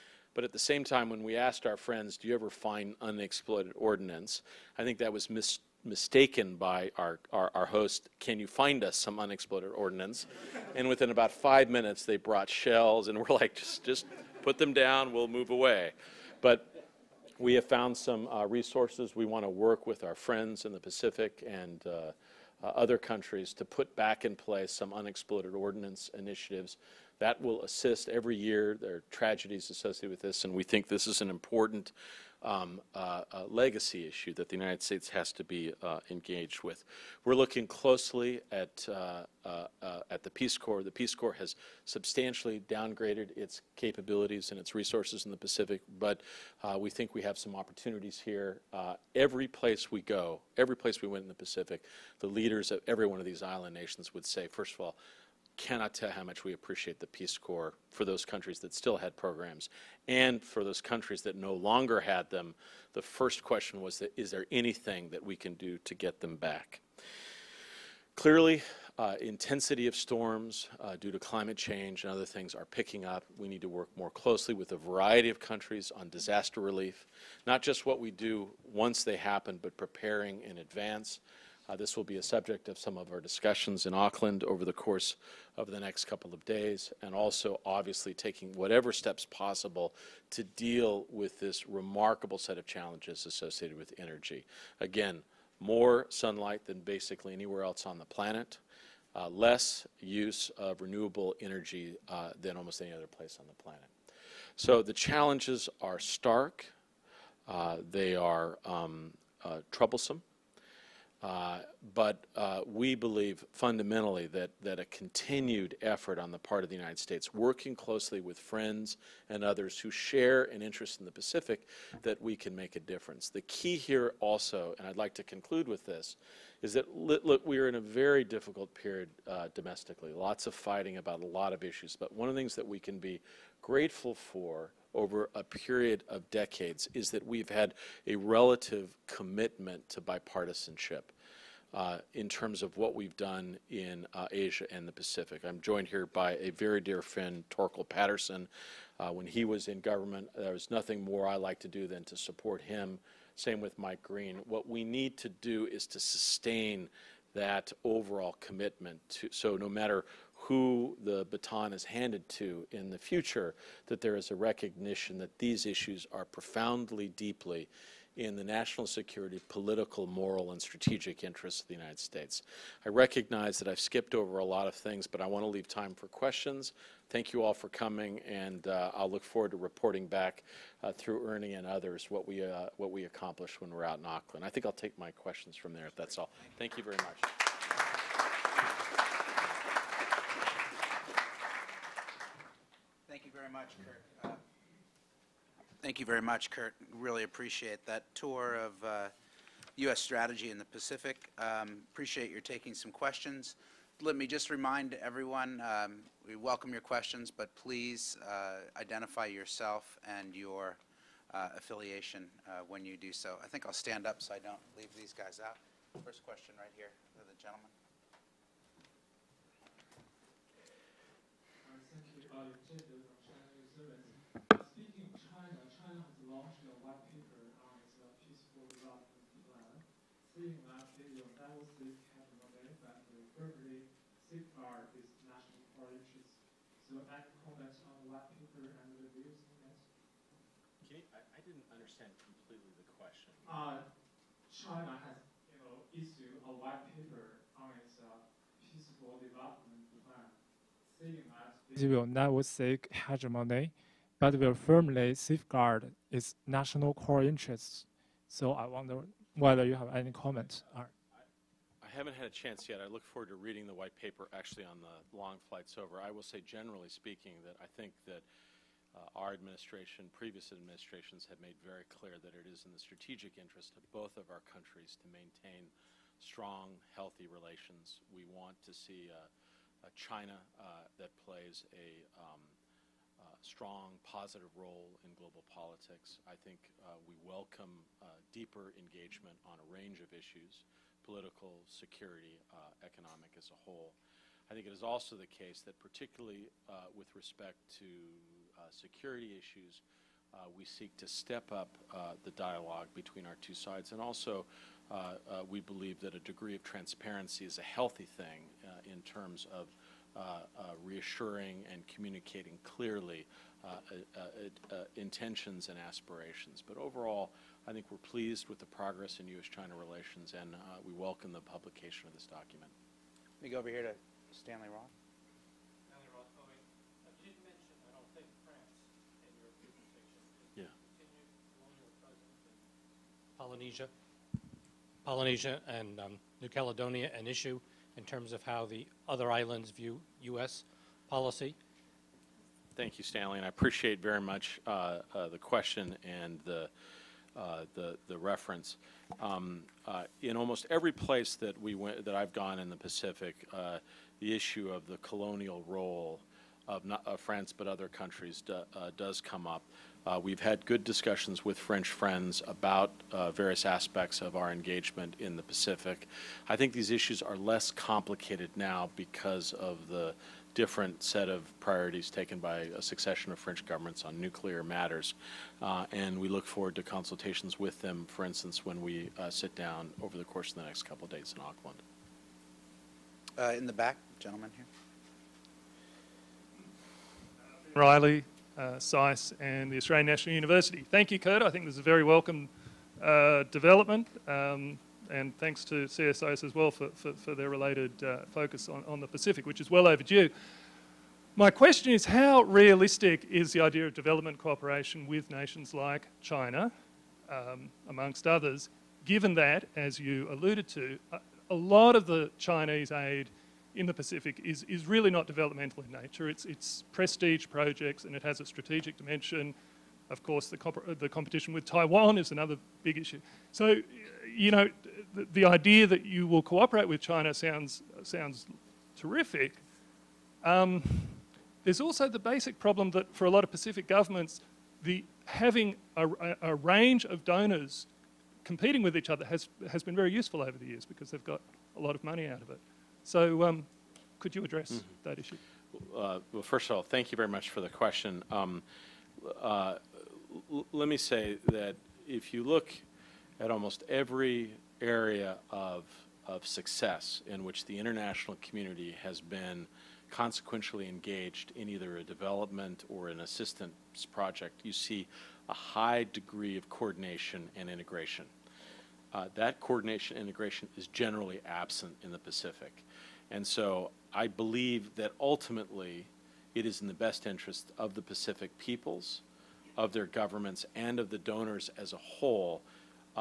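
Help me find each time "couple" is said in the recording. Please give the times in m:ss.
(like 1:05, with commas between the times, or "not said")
1:26, 6:20.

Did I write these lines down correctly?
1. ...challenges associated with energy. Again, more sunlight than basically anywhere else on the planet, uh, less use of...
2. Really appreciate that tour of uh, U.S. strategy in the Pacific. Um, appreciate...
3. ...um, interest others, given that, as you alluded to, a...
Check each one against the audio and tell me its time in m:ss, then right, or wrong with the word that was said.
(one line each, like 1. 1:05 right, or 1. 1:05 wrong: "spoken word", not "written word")
1. 1:32 right
2. 3:16 right
3. 6:47 wrong: "amongst", not "interest".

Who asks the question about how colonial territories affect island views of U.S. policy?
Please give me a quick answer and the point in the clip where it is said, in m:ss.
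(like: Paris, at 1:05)
Stanley Roth, at 5:24.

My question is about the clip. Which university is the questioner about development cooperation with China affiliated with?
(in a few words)
Australian National University.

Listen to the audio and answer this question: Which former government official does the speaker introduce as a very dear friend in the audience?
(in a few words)
Torkel Patterson.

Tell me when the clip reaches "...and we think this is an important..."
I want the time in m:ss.
0:30.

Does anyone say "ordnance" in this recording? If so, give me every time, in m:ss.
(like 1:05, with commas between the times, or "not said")
0:03, 0:09, 0:25.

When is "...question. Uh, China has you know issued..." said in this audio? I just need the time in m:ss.
4:02.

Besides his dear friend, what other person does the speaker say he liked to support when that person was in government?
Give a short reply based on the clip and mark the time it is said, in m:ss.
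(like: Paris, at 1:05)
Mike Green, at 2:33.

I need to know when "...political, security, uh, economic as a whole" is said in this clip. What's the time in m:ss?
4:51.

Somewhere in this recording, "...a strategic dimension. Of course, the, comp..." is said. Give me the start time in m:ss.
6:58.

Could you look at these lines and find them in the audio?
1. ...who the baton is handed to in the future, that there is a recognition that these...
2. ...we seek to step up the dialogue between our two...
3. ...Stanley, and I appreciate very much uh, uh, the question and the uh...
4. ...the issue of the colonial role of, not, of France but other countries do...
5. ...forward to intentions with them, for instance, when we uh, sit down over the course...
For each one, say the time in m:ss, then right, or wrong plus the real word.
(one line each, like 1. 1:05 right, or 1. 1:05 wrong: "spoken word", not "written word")
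1. 2:40 right
2. 5:00 right
3. 5:43 right
4. 5:54 right
5. 6:16 wrong: "consultations", not "intentions".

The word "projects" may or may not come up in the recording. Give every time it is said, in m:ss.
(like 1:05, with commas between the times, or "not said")
6:57, 7:44.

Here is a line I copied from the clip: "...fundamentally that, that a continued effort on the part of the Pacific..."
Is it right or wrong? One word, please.
wrong.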